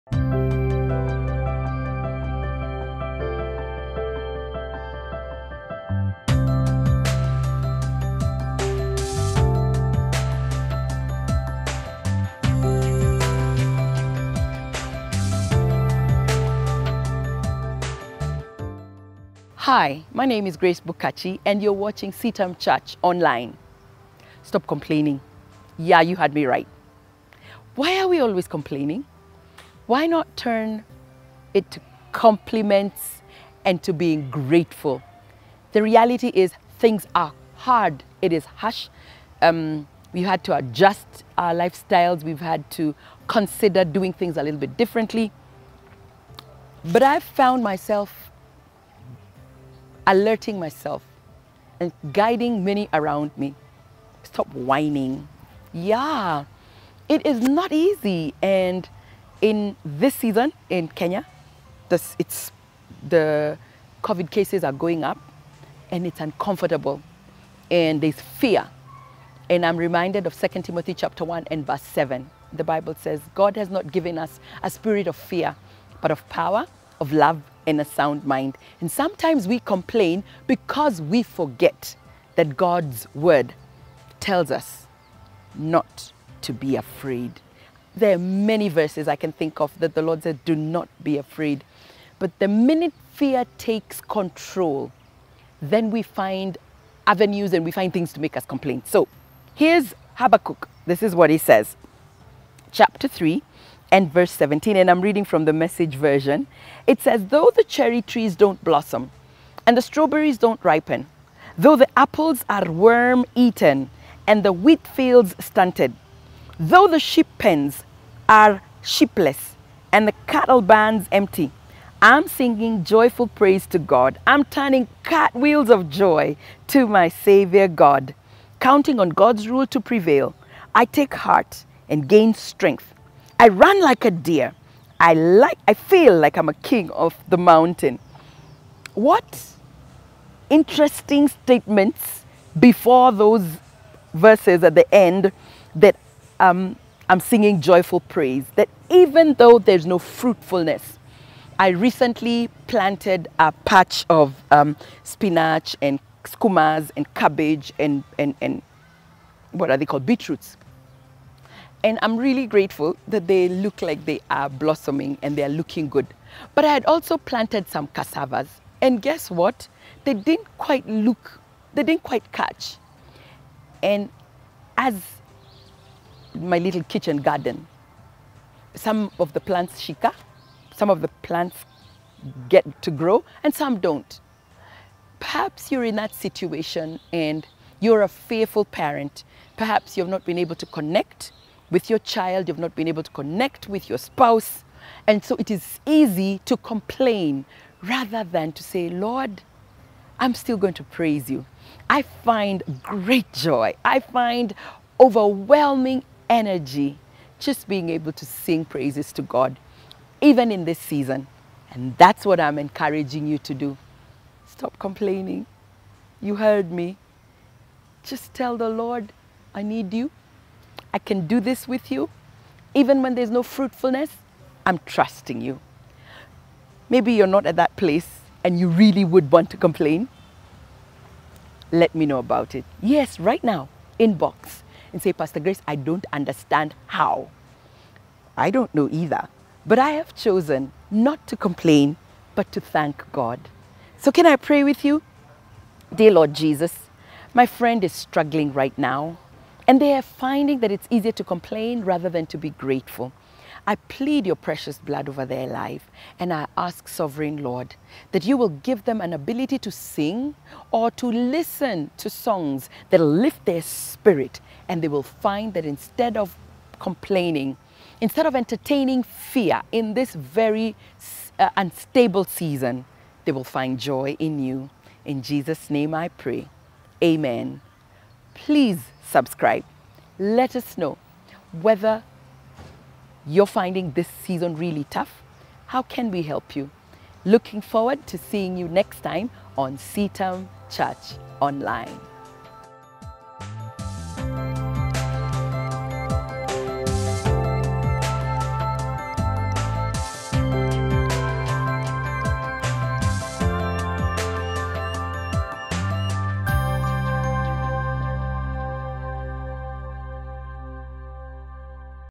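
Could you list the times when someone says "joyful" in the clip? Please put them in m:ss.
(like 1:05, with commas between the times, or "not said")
2:02, 2:27.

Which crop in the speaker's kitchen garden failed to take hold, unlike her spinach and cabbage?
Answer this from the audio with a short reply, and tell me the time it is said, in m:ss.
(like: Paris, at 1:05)
Cassavas, at 2:47.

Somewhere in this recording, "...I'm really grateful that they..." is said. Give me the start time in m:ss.
2:42.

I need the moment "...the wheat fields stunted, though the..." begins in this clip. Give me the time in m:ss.
1:54.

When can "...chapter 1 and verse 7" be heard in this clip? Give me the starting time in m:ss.
1:10.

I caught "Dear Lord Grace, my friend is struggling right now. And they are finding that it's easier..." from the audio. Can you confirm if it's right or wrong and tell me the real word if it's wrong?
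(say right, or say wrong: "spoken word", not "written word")
wrong: "Jesus", not "Grace".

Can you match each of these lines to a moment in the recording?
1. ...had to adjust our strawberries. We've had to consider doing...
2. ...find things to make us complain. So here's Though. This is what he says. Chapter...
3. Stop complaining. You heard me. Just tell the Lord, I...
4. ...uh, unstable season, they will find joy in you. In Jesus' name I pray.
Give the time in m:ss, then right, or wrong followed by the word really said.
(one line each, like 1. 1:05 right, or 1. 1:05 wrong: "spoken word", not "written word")
1. 0:40 wrong: "lifestyles", not "strawberries"
2. 1:37 wrong: "Habakkuk", not "Though"
3. 3:34 right
4. 4:31 right.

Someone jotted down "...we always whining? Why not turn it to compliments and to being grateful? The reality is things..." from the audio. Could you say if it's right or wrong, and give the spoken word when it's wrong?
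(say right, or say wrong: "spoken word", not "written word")
wrong: "complaining", not "whining".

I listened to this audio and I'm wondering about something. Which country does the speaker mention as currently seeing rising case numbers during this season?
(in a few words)
Kenya.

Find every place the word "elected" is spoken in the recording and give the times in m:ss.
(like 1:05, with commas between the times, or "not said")
not said.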